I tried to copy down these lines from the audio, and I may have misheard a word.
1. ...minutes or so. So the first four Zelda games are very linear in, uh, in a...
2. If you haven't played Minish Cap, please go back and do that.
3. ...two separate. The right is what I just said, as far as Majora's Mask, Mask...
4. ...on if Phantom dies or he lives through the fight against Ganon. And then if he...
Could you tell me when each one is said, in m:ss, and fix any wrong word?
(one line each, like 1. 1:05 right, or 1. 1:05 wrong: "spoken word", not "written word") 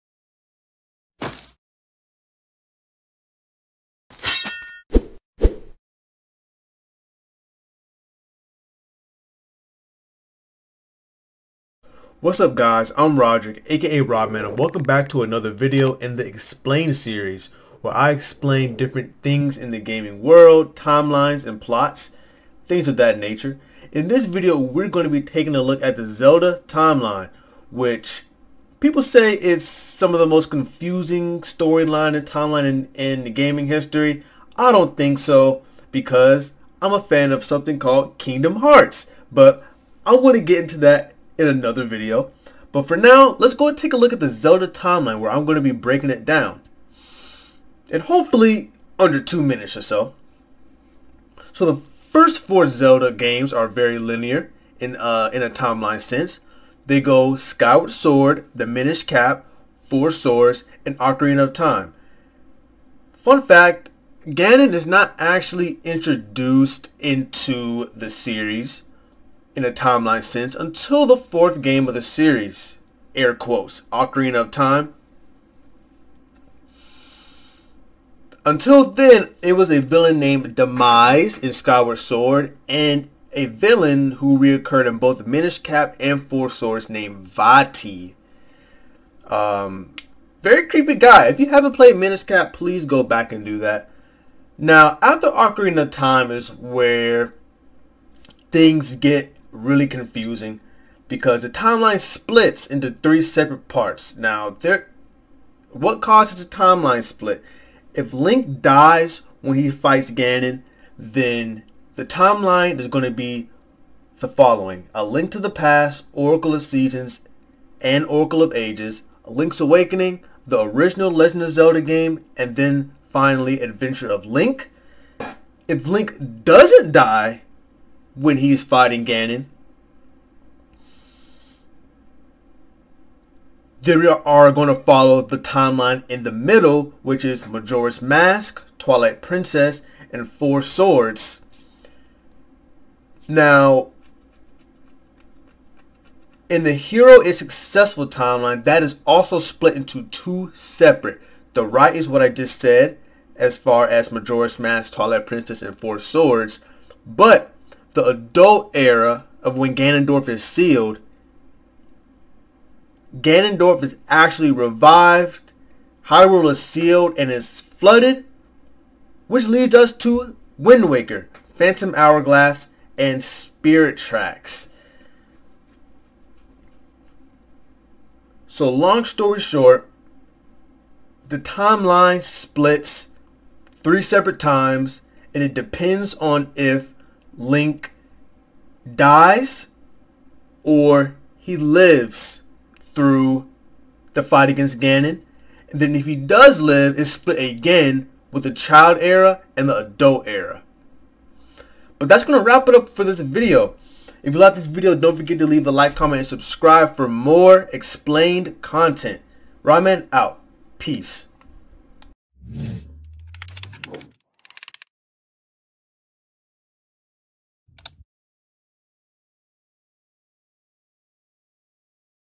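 1. 0:49 right
2. 1:31 right
3. 2:30 wrong: "Twilight", not "Mask"
4. 3:06 wrong: "Link", not "Phantom".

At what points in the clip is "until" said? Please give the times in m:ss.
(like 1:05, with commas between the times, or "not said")
1:10, 1:18.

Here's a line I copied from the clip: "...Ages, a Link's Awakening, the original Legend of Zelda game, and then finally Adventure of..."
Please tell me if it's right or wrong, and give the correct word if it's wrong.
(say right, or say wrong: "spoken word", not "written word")
right.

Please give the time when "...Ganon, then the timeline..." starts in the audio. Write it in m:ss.
1:50.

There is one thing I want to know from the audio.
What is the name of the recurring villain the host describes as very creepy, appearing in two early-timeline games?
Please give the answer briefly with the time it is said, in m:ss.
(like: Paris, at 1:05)
Vaati, at 1:27.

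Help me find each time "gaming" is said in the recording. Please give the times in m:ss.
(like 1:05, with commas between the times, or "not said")
0:19, 0:33.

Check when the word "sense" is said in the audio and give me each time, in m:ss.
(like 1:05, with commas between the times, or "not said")
0:56, 1:10.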